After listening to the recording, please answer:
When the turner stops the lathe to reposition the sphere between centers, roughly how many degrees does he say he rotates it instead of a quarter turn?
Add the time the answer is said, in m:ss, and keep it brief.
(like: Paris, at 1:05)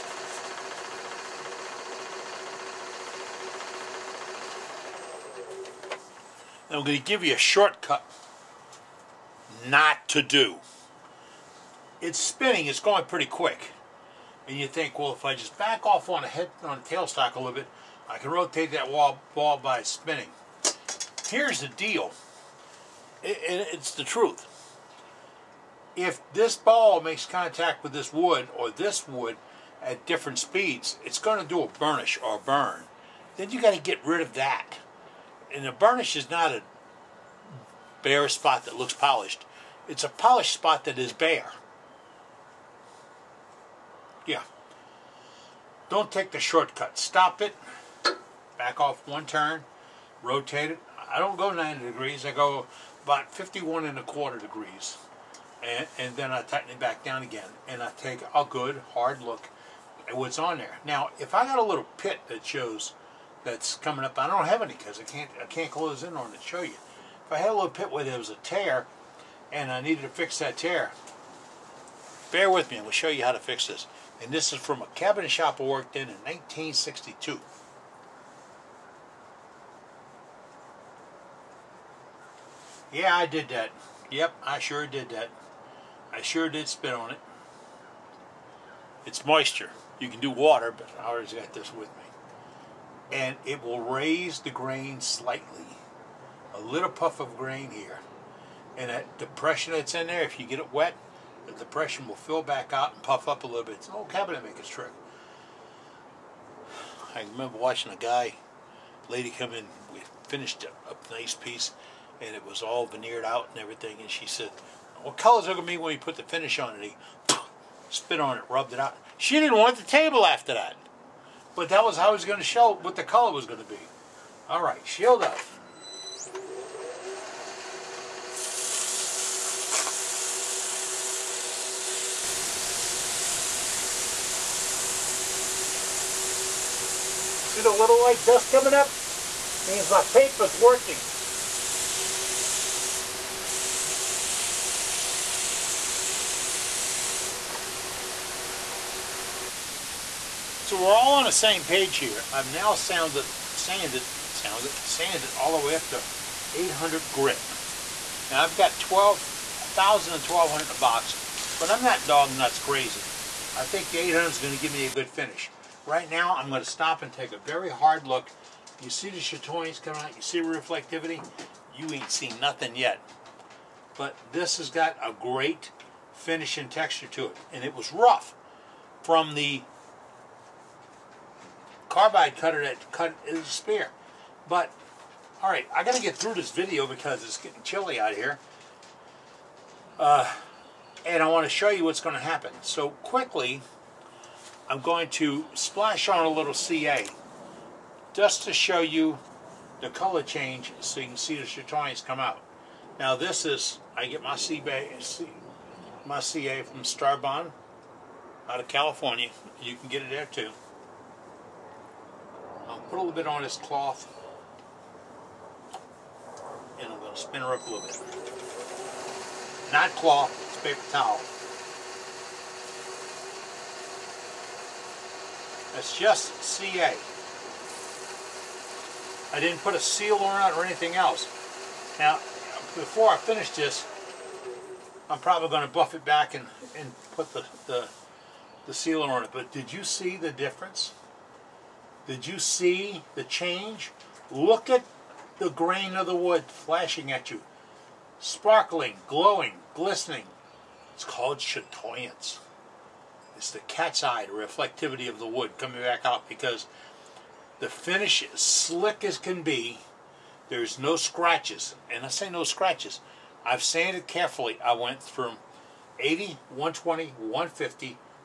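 51 and a quarter degrees, at 0:53.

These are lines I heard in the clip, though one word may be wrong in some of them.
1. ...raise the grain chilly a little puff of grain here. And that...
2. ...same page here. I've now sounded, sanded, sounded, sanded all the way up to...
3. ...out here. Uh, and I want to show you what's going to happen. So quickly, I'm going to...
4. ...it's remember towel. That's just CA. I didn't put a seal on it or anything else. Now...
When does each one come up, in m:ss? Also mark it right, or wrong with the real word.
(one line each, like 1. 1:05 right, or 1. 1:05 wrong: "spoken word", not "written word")
1. 1:33 wrong: "slightly", not "chilly"
2. 2:31 right
3. 3:07 right
4. 3:40 wrong: "paper", not "remember".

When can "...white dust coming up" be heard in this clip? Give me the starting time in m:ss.
2:17.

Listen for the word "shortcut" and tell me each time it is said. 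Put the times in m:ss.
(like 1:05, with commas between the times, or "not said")
0:07, 0:46.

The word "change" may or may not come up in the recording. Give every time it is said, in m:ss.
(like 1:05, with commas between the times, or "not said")
3:20, 4:03.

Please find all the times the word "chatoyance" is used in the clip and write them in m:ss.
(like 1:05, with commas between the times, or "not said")
2:49, 3:21, 4:11.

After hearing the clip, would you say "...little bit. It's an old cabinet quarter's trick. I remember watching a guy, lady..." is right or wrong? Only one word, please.
wrong.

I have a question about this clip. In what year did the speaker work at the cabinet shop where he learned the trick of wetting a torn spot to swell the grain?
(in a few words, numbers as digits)
1962.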